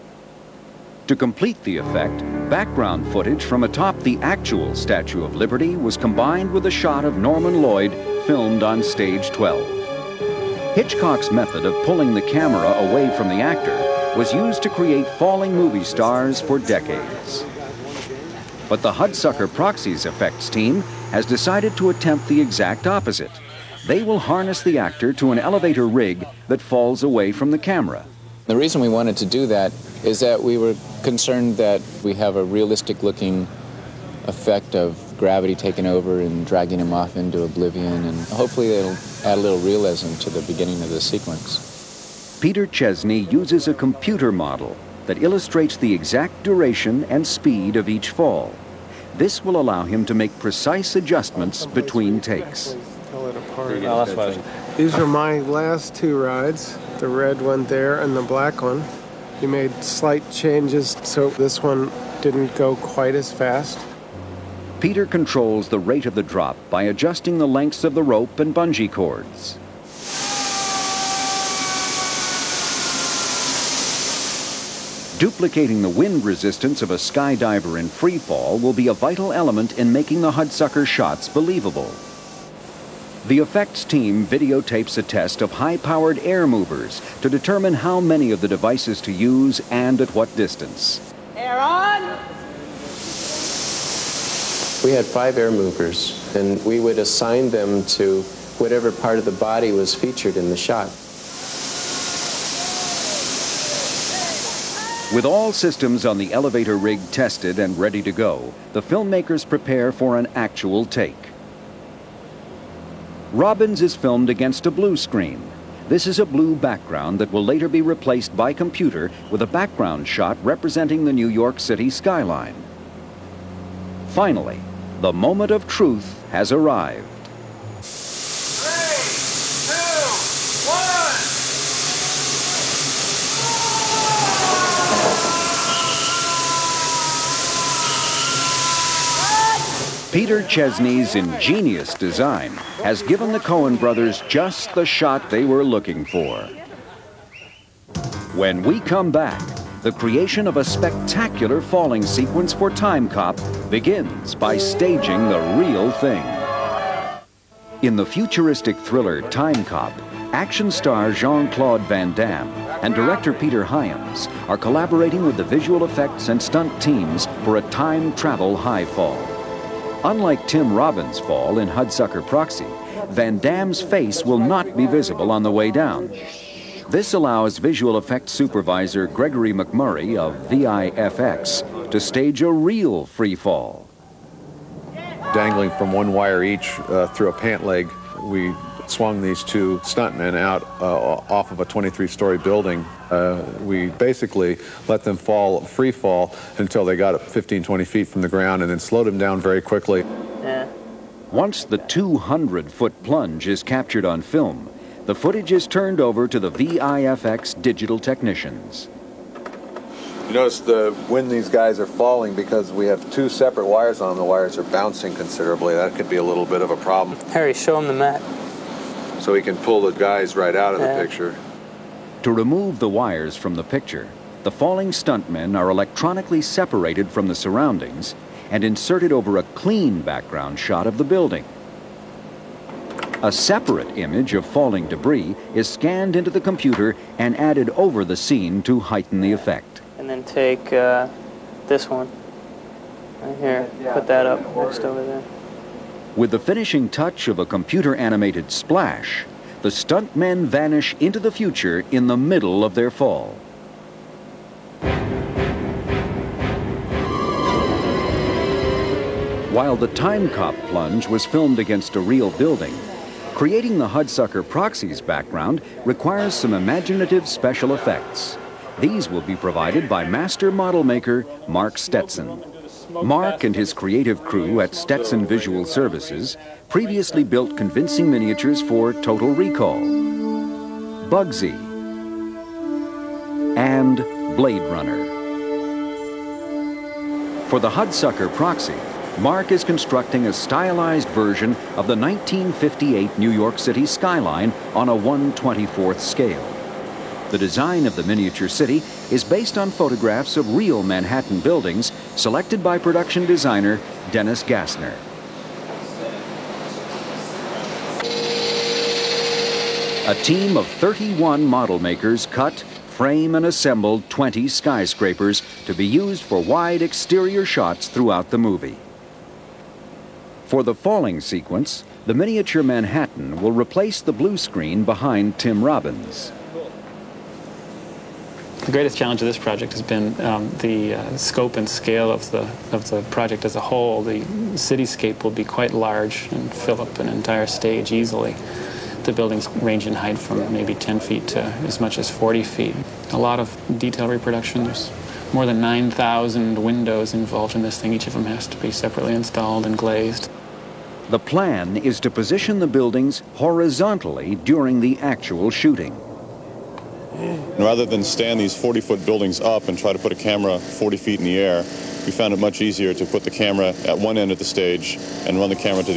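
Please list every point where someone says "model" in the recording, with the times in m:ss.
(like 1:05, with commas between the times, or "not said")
0:44, 4:30, 5:11.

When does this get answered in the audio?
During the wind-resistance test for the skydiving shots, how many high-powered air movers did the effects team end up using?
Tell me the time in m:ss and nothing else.
1:35.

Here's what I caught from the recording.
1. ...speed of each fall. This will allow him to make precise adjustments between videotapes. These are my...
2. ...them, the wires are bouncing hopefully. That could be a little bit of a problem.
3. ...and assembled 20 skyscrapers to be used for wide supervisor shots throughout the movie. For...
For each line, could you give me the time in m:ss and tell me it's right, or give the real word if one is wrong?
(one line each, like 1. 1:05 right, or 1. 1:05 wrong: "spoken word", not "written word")
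1. 0:47 wrong: "takes", not "videotapes"
2. 3:34 wrong: "considerably", not "hopefully"
3. 5:13 wrong: "exterior", not "supervisor".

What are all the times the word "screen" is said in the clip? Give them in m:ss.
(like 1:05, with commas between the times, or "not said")
1:54, 5:24.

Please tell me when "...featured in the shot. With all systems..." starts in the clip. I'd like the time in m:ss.
1:39.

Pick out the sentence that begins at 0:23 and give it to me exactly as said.
They will harness the actor to an elevator rig that falls away from the camera.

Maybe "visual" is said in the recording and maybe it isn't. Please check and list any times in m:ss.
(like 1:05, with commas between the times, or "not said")
2:45, 2:57, 4:35.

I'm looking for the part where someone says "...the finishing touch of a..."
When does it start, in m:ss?
4:06.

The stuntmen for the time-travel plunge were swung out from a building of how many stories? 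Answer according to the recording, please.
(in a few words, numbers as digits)
23.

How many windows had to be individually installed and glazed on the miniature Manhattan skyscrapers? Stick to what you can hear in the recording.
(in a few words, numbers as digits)
9,000.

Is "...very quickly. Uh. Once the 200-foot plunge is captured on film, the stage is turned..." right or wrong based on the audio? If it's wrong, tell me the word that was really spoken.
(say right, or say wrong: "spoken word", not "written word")
wrong: "footage", not "stage".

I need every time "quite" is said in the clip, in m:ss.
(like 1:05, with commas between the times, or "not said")
1:02, 5:35.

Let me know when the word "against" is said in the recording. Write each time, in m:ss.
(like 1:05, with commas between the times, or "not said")
1:54, 4:21.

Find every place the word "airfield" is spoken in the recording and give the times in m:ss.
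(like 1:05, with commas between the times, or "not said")
not said.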